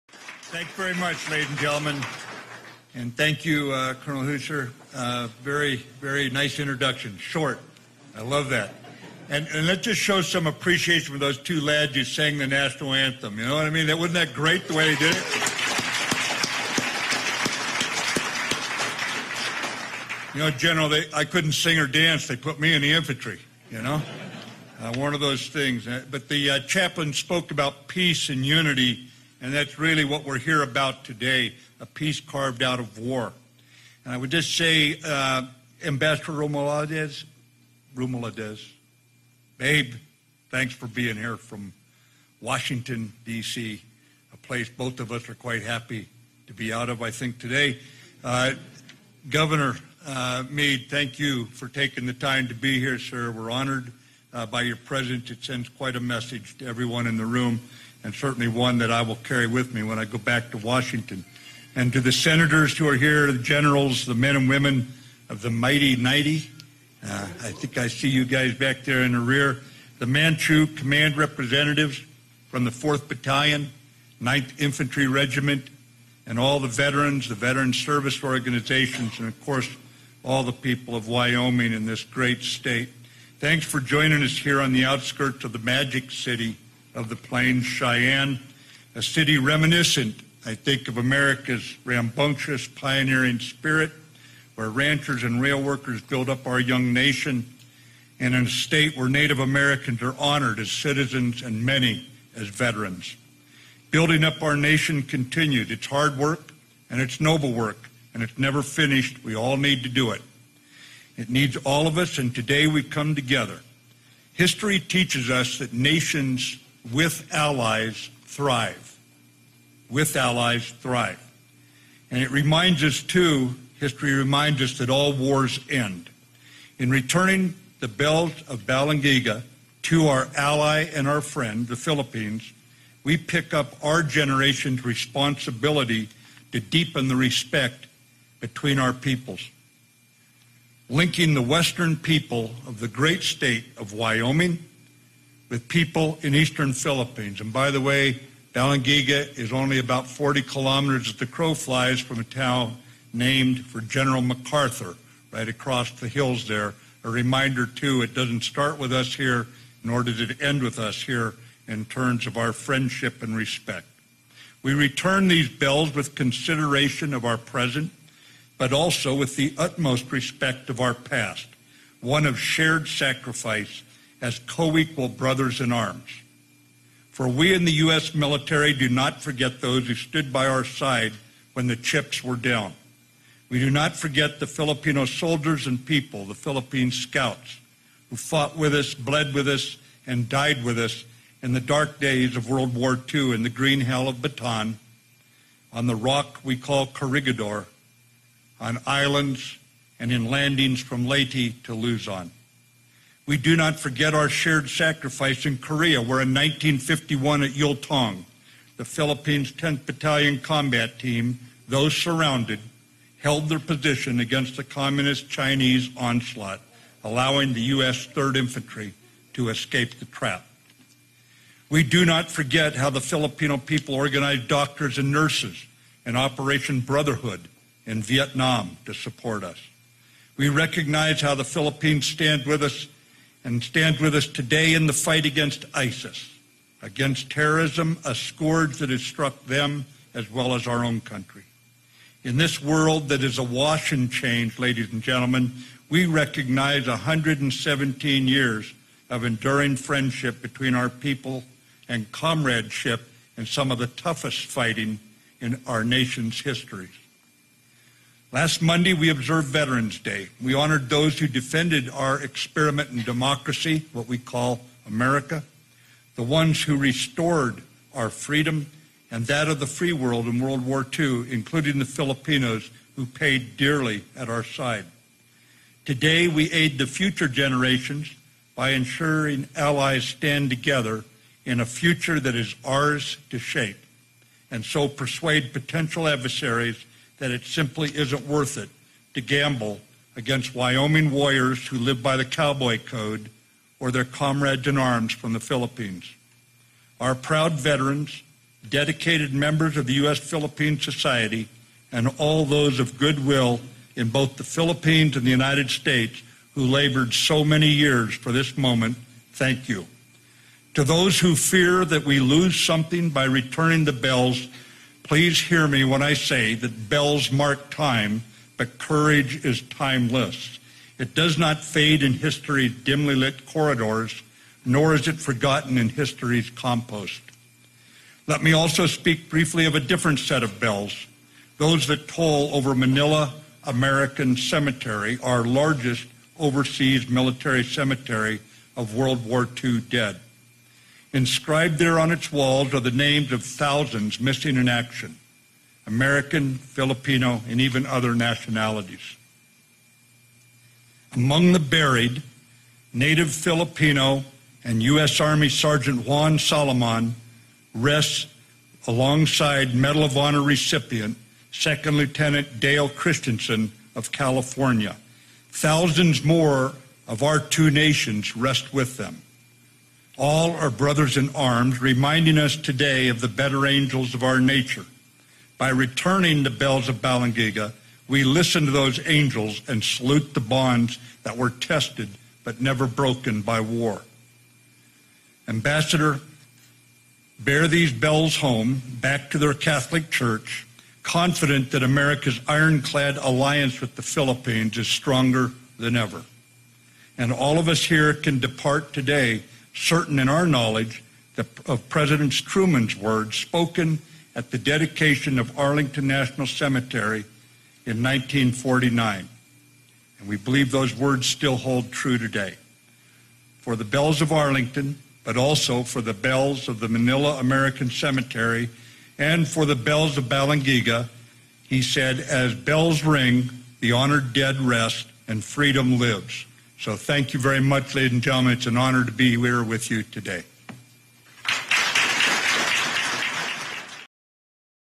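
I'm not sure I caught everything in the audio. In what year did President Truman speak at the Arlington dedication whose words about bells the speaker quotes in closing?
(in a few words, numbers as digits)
1949.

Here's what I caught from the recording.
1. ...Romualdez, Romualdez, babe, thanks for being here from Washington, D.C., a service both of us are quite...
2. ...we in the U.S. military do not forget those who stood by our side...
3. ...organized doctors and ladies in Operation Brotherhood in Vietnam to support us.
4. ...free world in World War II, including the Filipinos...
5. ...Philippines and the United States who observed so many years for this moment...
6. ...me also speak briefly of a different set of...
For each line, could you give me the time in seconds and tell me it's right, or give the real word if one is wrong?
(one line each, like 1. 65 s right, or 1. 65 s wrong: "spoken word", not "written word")
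1. 36 s wrong: "place", not "service"
2. 177 s right
3. 223 s wrong: "nurses", not "ladies"
4. 269 s right
5. 304 s wrong: "labored", not "observed"
6. 328 s right.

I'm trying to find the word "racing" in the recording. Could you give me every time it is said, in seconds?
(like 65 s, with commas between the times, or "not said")
not said.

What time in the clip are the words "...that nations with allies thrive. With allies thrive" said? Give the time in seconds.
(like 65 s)
115 s.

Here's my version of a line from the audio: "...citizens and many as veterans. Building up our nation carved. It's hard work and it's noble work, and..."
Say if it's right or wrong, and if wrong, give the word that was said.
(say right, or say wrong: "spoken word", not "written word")
wrong: "continued", not "carved".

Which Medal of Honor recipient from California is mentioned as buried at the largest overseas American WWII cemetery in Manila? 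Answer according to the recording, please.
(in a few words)
Dale Christensen.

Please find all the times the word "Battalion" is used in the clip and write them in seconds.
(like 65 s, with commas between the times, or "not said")
73 s, 209 s.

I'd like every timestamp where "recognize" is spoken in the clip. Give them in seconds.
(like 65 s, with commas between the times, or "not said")
230 s, 246 s.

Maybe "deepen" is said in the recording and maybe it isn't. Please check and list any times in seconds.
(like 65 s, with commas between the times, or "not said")
136 s.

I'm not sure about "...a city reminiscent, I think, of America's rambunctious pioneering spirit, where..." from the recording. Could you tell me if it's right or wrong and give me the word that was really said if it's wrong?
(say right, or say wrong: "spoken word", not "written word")
right.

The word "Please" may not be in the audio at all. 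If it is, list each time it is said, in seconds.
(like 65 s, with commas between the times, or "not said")
315 s.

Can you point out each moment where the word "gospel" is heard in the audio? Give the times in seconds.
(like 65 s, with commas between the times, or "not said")
not said.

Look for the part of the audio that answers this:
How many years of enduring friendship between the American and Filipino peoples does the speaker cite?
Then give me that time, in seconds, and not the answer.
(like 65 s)
246 s.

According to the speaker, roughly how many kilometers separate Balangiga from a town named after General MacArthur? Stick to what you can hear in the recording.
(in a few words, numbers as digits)
40.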